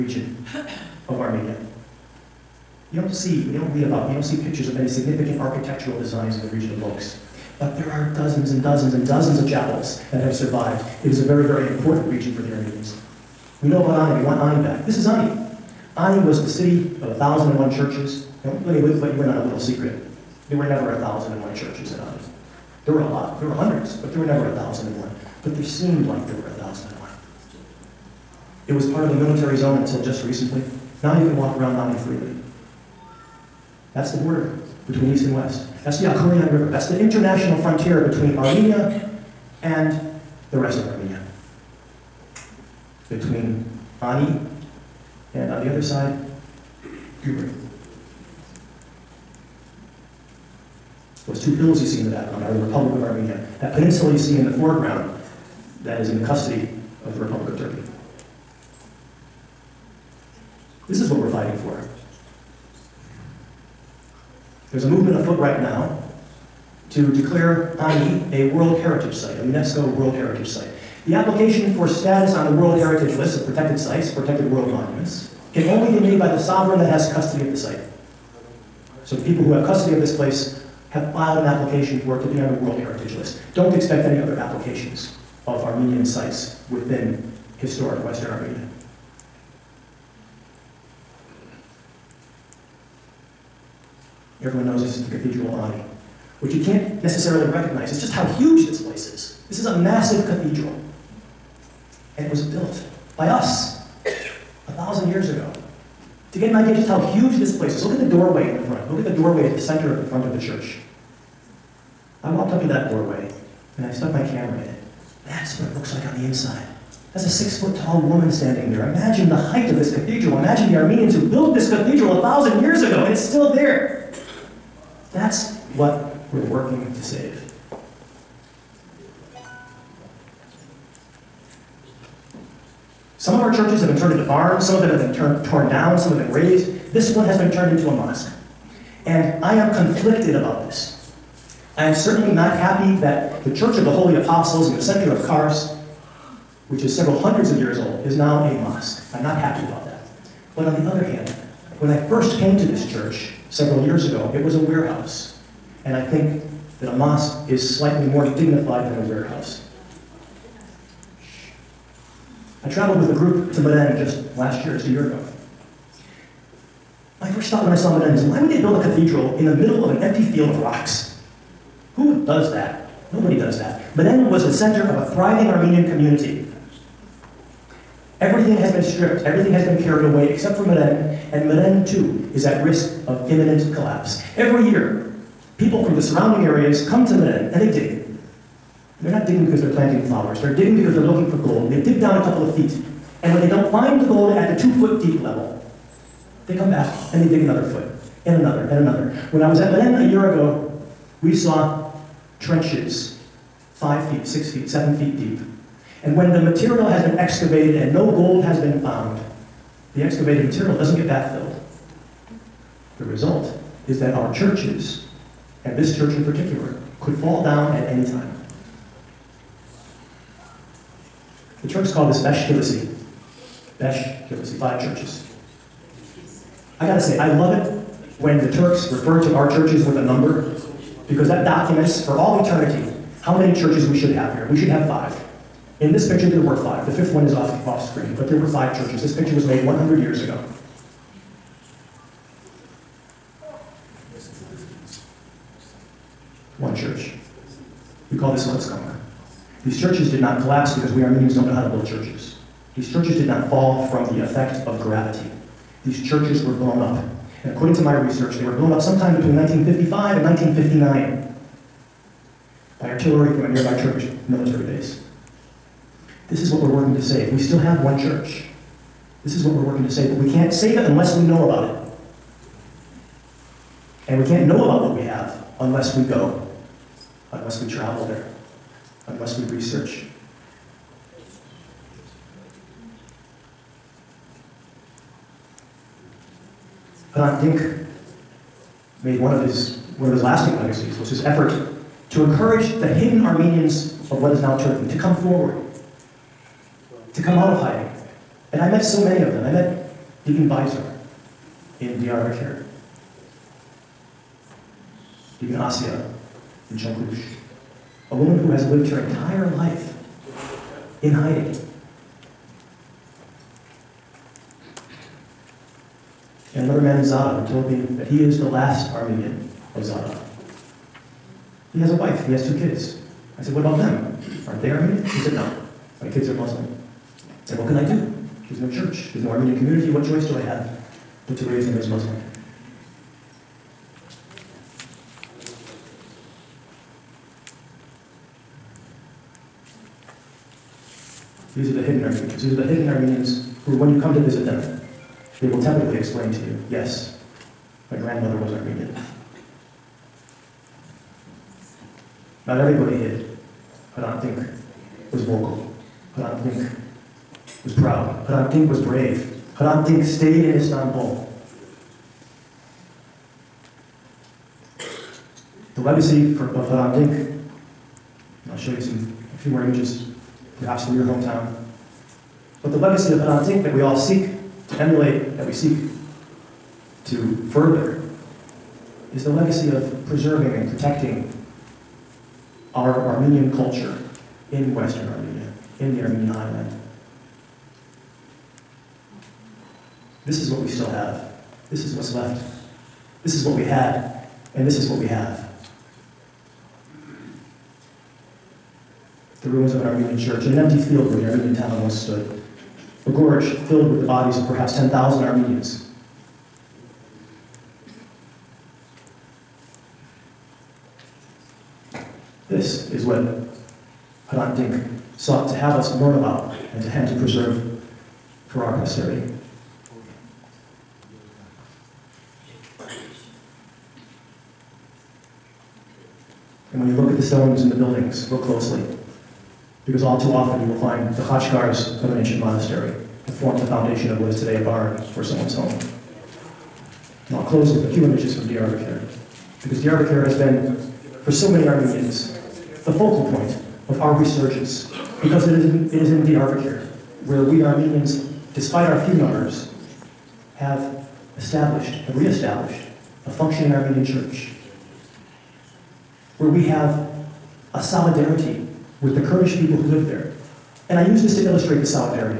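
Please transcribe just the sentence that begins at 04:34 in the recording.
And we can't know about what we have unless we go, unless we travel there, unless we research.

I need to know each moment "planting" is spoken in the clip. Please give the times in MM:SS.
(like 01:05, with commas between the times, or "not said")
03:09.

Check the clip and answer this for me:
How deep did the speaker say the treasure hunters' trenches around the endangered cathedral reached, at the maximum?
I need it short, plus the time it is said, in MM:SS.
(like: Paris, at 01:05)
7 feet, at 03:24.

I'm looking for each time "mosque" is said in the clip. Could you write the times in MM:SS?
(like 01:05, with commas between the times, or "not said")
02:17, 02:28, 02:36.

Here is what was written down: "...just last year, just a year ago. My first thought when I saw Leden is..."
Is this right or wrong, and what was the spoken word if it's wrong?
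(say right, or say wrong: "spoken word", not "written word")
right.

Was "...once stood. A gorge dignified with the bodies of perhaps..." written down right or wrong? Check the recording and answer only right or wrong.
wrong.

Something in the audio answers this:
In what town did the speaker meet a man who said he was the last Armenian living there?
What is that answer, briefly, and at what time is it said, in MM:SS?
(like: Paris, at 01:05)
Zara, at 05:17.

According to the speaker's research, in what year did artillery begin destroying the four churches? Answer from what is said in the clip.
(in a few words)
1955.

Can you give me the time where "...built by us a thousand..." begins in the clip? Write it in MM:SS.
01:42.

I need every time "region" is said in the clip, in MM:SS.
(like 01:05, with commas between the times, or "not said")
00:06, 00:12.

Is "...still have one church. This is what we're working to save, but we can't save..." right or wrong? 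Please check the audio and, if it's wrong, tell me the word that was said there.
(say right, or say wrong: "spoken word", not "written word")
right.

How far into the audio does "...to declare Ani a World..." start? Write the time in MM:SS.
01:06.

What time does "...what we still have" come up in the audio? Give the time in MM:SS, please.
06:30.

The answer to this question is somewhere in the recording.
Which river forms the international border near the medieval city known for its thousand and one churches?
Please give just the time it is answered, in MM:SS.
00:36.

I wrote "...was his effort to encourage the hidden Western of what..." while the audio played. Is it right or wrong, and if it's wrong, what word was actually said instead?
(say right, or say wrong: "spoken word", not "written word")
wrong: "Armenians", not "Western".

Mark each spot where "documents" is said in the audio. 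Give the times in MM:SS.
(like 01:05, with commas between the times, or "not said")
03:51.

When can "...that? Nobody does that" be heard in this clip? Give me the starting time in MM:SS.
02:52.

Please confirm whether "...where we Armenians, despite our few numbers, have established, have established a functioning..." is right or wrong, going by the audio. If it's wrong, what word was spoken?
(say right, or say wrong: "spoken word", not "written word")
right.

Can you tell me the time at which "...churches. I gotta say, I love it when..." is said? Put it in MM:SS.
03:44.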